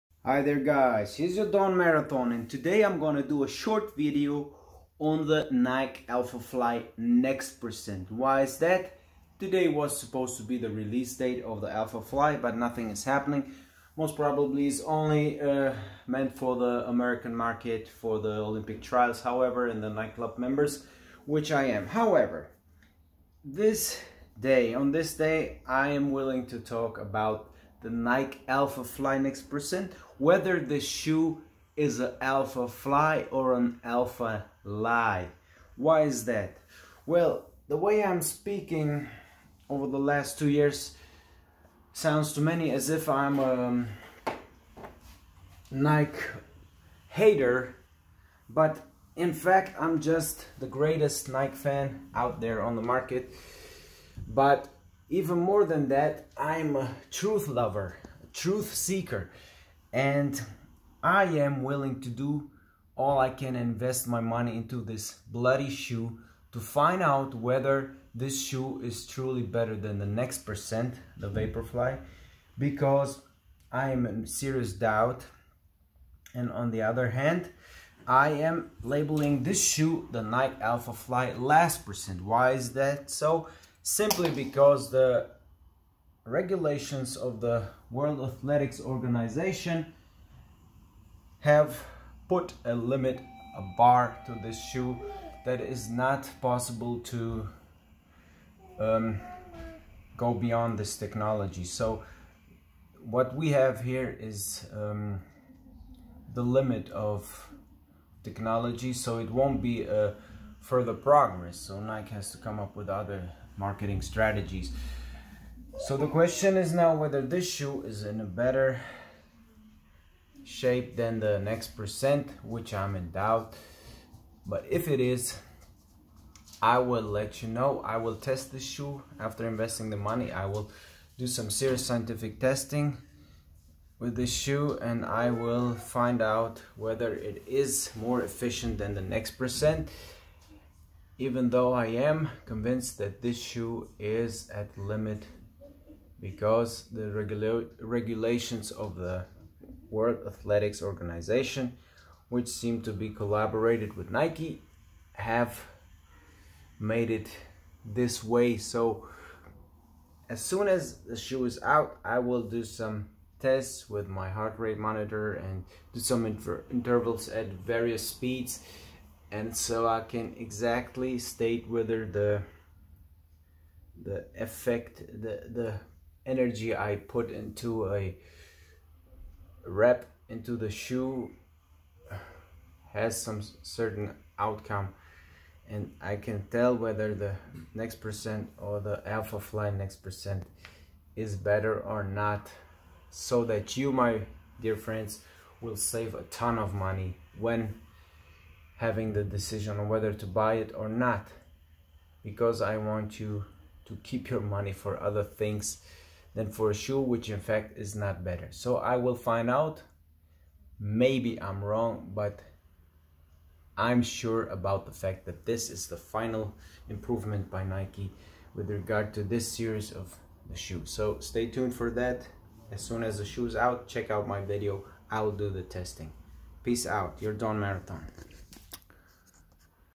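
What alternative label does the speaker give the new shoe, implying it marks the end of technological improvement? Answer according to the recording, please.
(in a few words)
Nike Alphafly last percent.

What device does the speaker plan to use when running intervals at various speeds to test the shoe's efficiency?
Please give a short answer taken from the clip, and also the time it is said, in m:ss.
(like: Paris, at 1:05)
heart rate monitor, at 2:44.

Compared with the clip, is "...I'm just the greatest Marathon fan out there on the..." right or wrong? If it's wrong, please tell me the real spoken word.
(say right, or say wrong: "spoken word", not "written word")
wrong: "Nike", not "Marathon".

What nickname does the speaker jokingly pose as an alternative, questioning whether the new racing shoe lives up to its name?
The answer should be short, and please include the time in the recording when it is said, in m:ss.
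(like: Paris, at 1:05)
Alpha Lie, at 0:33.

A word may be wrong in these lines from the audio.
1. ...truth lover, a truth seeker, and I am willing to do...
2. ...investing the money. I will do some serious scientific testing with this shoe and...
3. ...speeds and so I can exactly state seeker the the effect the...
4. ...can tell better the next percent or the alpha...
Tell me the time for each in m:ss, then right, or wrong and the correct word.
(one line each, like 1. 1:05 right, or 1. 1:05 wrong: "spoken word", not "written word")
1. 0:57 right
2. 2:09 right
3. 2:48 wrong: "whether", not "seeker"
4. 3:06 wrong: "whether", not "better".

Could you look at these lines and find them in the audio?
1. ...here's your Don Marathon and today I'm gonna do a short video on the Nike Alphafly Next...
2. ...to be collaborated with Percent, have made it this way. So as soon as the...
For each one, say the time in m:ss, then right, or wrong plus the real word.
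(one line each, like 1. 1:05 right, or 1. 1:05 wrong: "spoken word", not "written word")
1. 0:01 right
2. 2:32 wrong: "Nike", not "Percent".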